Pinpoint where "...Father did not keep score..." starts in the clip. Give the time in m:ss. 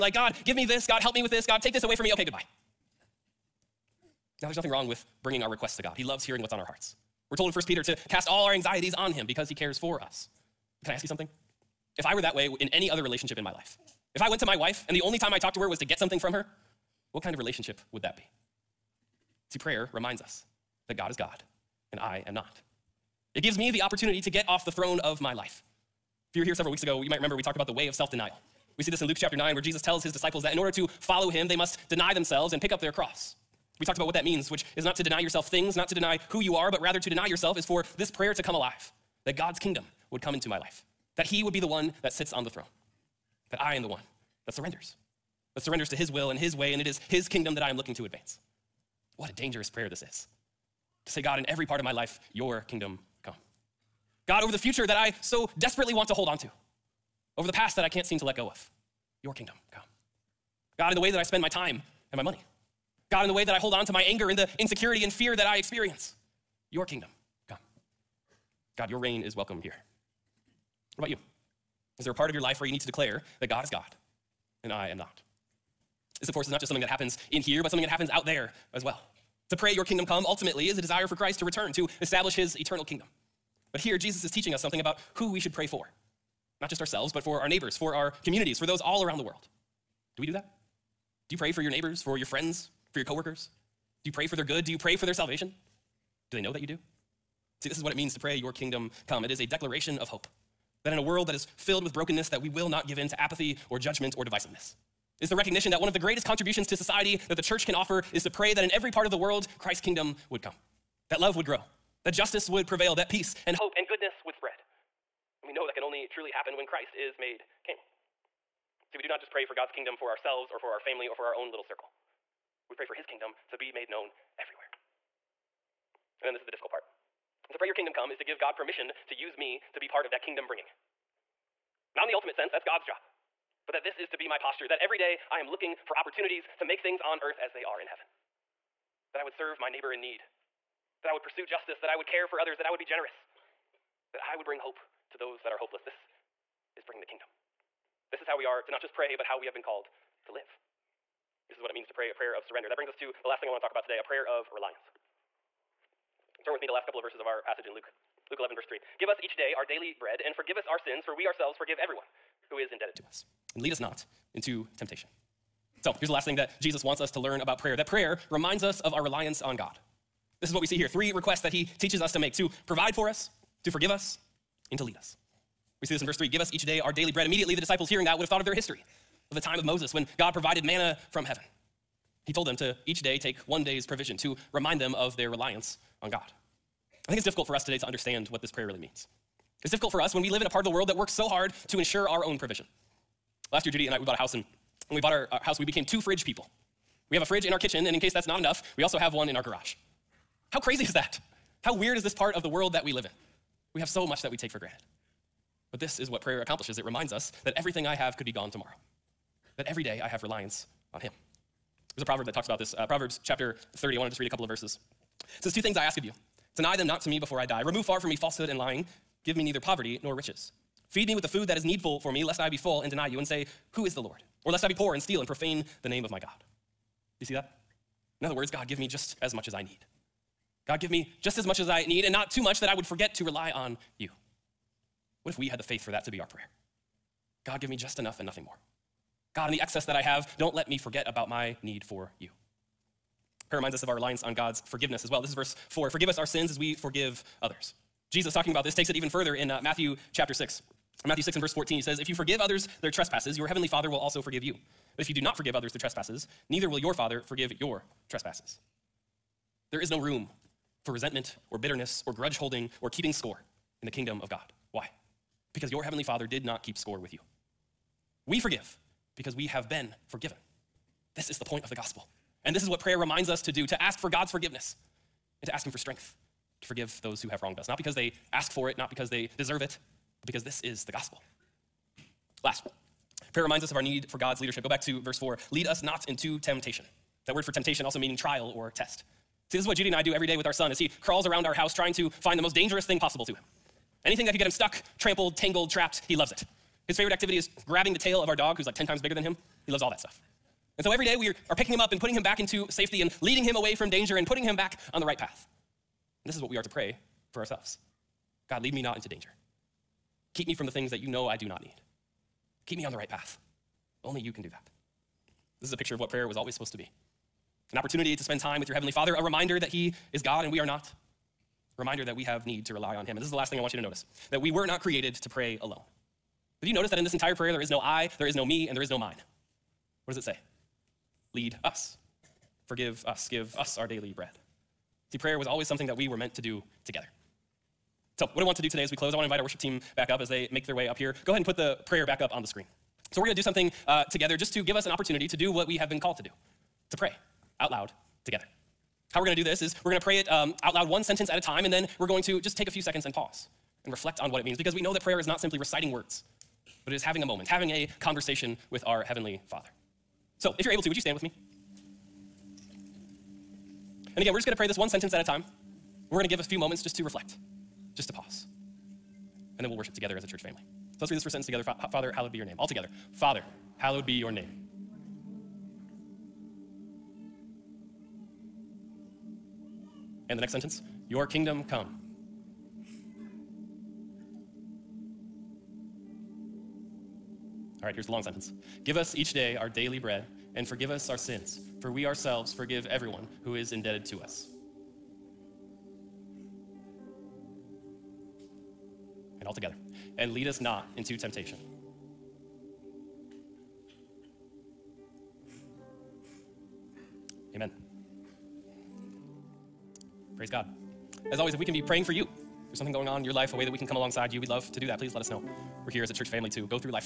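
4:26.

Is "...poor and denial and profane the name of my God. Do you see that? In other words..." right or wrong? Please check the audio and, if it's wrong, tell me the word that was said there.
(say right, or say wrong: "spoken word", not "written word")
wrong: "steal", not "denial".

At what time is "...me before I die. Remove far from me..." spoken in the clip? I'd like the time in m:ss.
3:37.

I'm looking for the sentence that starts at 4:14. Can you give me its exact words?
But if you do not forgive others their trespasses, neither will your Father forgive your trespasses.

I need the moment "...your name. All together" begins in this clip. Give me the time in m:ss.
6:12.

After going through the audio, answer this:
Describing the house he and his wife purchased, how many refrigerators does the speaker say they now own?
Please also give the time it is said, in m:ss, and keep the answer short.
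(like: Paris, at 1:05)
2, at 3:15.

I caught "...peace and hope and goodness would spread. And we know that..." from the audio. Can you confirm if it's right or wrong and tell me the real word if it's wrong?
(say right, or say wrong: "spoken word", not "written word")
right.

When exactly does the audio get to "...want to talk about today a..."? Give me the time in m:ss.
2:33.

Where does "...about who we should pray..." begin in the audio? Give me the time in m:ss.
1:24.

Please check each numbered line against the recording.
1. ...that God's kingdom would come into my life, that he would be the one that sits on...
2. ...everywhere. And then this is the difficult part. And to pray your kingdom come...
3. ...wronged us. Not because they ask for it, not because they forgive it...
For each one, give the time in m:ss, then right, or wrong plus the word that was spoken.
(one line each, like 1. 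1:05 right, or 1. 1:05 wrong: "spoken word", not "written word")
1. 0:39 right
2. 2:04 right
3. 4:37 wrong: "deserve", not "forgive".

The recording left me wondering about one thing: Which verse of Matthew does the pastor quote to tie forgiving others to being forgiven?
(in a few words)
Matthew 6:14.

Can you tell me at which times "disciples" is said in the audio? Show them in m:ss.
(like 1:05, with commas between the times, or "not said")
0:30, 2:57.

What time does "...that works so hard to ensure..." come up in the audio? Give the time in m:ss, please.
3:10.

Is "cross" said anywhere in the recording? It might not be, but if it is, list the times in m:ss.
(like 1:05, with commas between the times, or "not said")
0:32.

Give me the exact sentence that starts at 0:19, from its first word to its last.
See, prayer reminds us that God is God and I am not.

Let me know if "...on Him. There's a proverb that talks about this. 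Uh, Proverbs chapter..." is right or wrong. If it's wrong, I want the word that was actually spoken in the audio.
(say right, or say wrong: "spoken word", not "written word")
right.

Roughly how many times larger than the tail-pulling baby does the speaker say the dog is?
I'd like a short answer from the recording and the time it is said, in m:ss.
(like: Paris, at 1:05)
10, at 4:58.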